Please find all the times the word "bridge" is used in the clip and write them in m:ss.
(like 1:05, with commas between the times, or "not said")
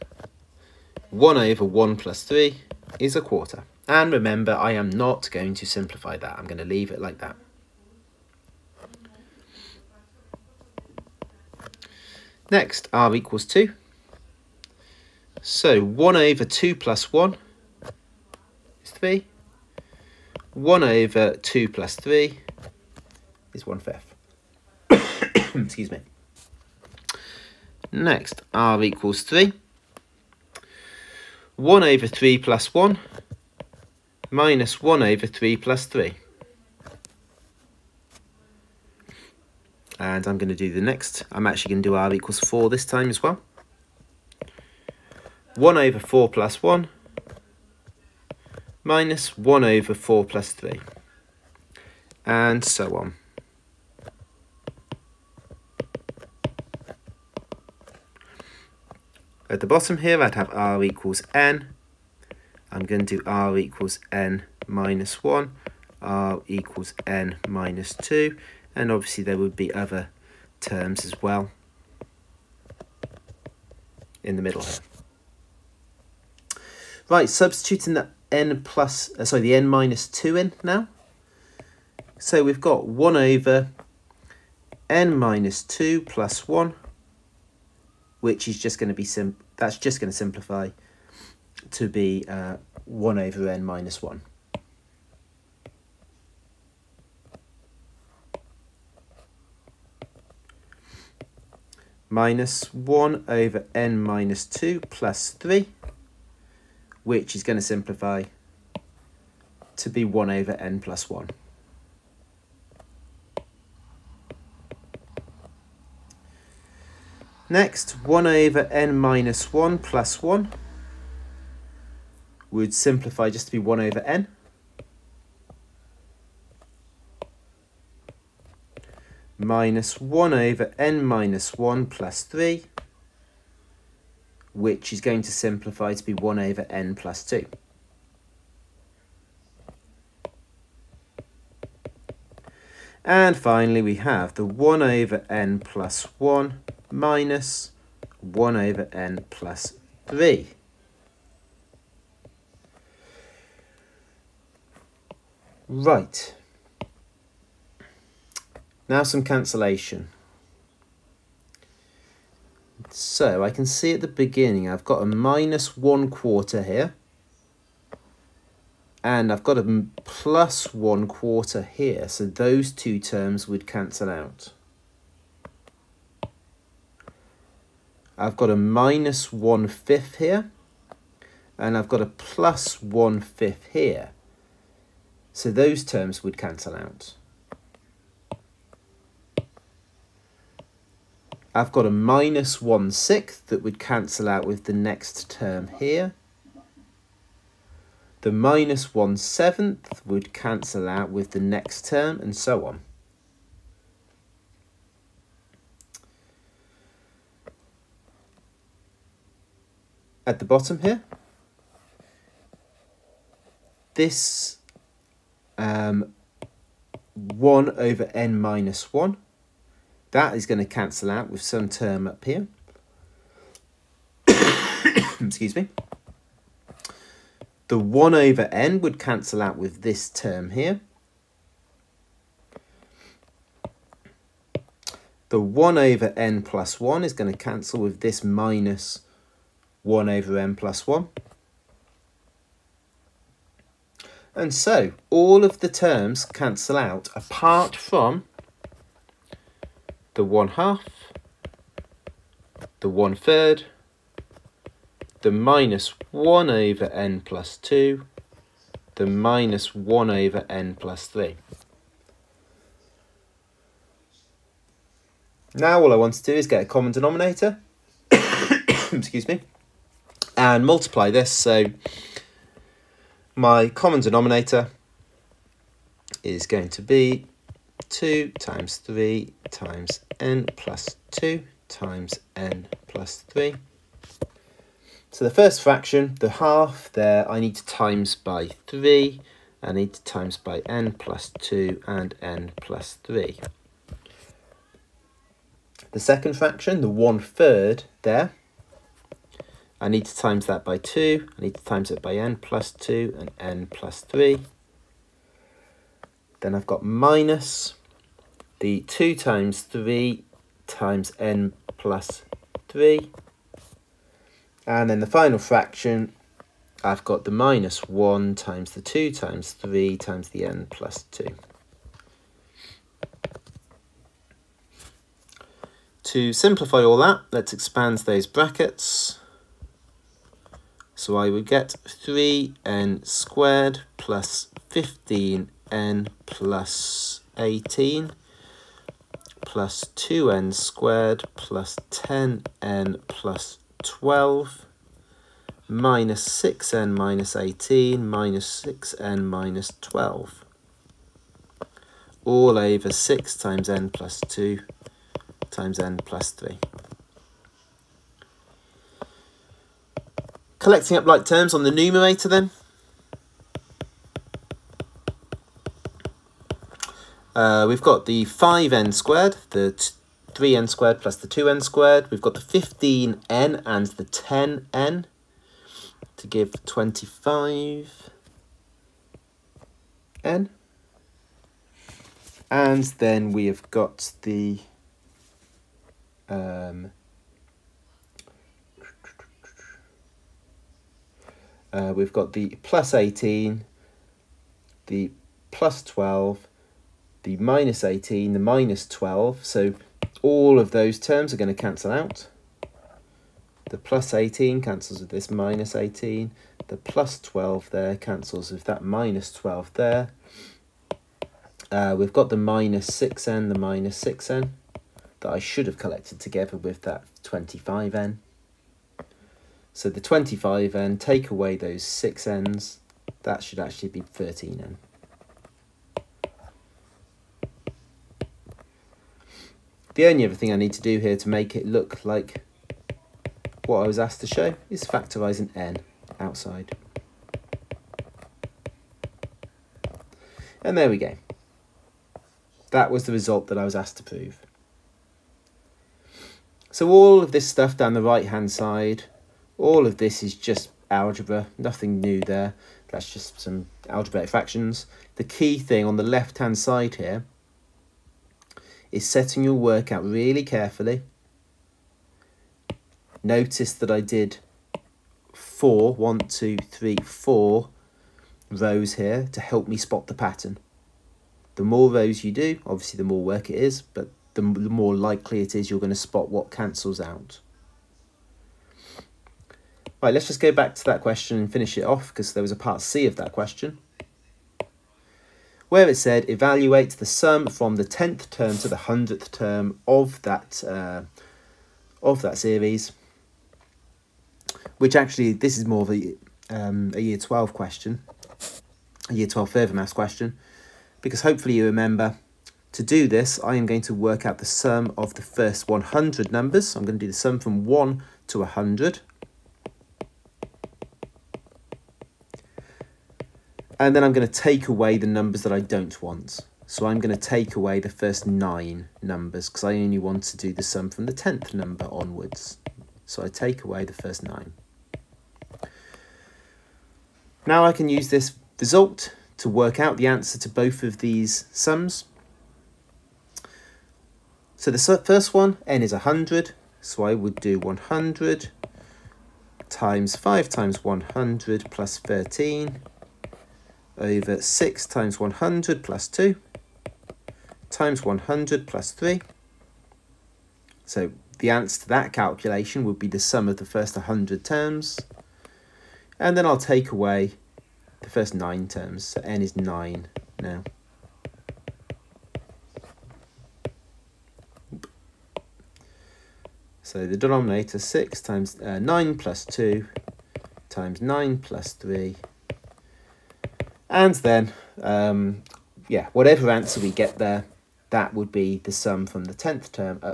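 not said.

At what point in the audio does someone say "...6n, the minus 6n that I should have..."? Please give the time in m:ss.
6:52.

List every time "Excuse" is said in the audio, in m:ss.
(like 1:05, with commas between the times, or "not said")
0:25, 3:45, 4:28.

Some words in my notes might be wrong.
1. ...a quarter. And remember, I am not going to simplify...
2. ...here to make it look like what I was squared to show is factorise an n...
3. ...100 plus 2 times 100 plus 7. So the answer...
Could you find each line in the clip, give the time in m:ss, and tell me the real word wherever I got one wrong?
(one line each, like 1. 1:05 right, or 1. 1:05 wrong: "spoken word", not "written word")
1. 0:03 right
2. 7:10 wrong: "asked", not "squared"
3. 9:05 wrong: "3", not "7".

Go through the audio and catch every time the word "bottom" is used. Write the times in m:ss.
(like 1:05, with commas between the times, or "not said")
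0:59, 3:30.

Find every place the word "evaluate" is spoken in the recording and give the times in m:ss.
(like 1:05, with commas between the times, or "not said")
8:06.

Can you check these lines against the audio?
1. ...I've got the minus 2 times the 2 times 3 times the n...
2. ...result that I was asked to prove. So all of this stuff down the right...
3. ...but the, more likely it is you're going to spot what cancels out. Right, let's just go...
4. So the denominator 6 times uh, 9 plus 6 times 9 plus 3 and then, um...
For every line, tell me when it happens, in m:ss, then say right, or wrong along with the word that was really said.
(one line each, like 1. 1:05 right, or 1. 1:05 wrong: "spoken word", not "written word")
1. 5:16 wrong: "1", not "2"
2. 7:23 right
3. 7:53 right
4. 9:26 wrong: "2", not "6".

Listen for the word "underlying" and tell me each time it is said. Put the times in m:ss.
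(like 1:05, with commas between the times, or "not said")
not said.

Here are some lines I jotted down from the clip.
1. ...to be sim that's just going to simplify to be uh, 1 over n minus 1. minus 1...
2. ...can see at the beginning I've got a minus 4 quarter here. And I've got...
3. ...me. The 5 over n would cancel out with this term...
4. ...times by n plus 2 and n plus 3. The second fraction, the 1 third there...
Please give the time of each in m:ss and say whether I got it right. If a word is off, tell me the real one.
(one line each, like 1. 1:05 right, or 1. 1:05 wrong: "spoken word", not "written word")
1. 1:28 right
2. 2:43 wrong: "1", not "4"
3. 3:45 wrong: "1", not "5"
4. 4:50 right.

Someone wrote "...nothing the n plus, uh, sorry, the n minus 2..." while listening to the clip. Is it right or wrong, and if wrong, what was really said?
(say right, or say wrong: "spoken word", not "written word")
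wrong: "substituting", not "nothing".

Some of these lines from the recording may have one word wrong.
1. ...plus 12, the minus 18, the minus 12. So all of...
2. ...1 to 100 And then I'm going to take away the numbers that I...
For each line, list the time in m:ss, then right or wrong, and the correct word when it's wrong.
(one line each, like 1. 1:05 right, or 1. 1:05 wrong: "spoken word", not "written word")
1. 6:35 right
2. 8:27 right.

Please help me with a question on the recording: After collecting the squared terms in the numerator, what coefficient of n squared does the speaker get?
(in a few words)
5n².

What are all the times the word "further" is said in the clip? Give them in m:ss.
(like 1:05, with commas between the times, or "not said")
8:19.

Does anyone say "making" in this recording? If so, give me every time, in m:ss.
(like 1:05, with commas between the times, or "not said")
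not said.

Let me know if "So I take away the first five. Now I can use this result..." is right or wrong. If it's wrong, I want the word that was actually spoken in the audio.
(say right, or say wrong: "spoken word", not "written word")
wrong: "nine", not "five".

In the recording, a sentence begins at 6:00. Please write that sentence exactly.
collecting up like terms on the numerator then.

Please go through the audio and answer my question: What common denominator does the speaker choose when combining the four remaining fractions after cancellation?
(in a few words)
2 × 3 × (n+2) × (n+3).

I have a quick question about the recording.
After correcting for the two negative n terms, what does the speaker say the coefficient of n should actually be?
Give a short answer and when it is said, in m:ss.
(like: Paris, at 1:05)
13n, at 7:04.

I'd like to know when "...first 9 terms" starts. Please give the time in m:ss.
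9:18.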